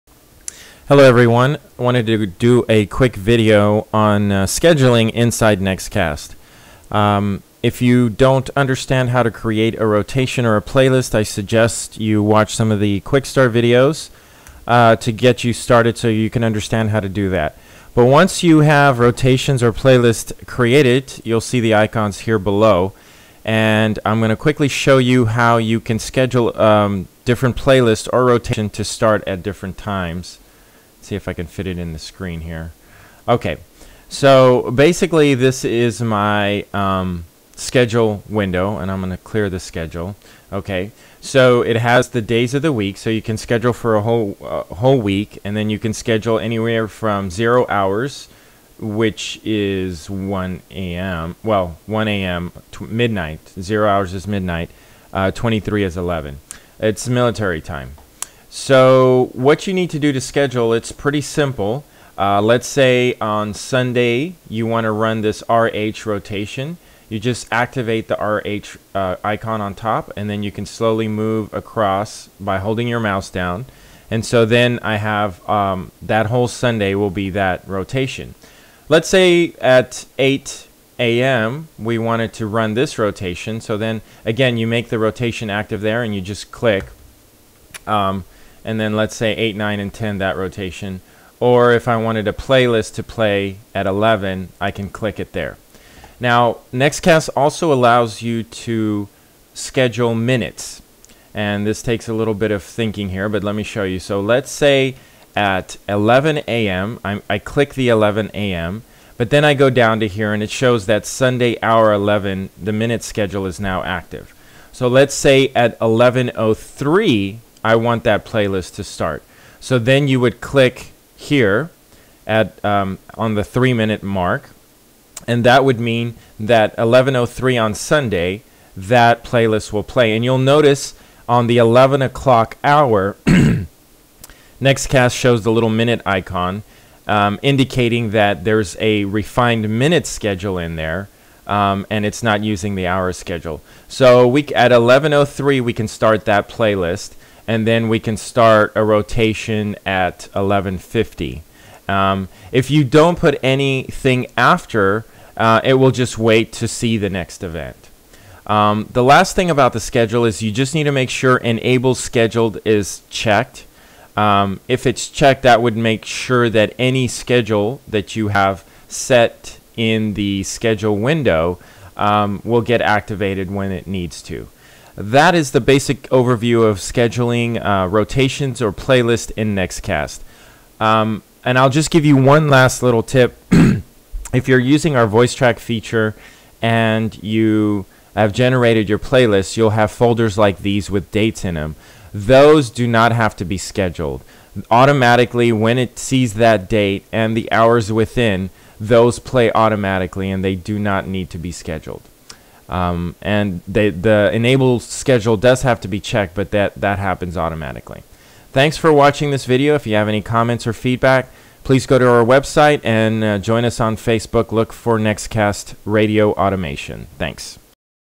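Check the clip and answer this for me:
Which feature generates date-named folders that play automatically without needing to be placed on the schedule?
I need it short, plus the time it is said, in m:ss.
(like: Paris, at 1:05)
Voice track, at 3:05.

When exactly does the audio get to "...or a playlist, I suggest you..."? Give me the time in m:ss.
0:10.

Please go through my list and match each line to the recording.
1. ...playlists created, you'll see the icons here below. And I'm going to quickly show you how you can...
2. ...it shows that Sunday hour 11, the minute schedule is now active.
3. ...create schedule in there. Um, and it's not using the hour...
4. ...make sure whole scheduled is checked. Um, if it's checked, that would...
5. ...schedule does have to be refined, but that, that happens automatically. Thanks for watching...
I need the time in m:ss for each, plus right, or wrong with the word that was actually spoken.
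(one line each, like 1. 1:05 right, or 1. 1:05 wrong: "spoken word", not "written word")
1. 0:19 right
2. 1:50 right
3. 2:19 wrong: "minute", not "create"
4. 2:40 wrong: "enable", not "whole"
5. 3:24 wrong: "checked", not "refined".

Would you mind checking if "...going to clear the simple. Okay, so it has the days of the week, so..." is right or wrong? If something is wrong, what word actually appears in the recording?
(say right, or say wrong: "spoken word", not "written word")
wrong: "schedule", not "simple".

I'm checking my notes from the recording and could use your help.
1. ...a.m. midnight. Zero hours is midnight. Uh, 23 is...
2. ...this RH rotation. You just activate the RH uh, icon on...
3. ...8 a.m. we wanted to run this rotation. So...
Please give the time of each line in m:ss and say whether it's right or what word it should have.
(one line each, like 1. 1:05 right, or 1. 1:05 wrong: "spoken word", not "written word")
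1. 0:52 right
2. 1:05 right
3. 1:20 right.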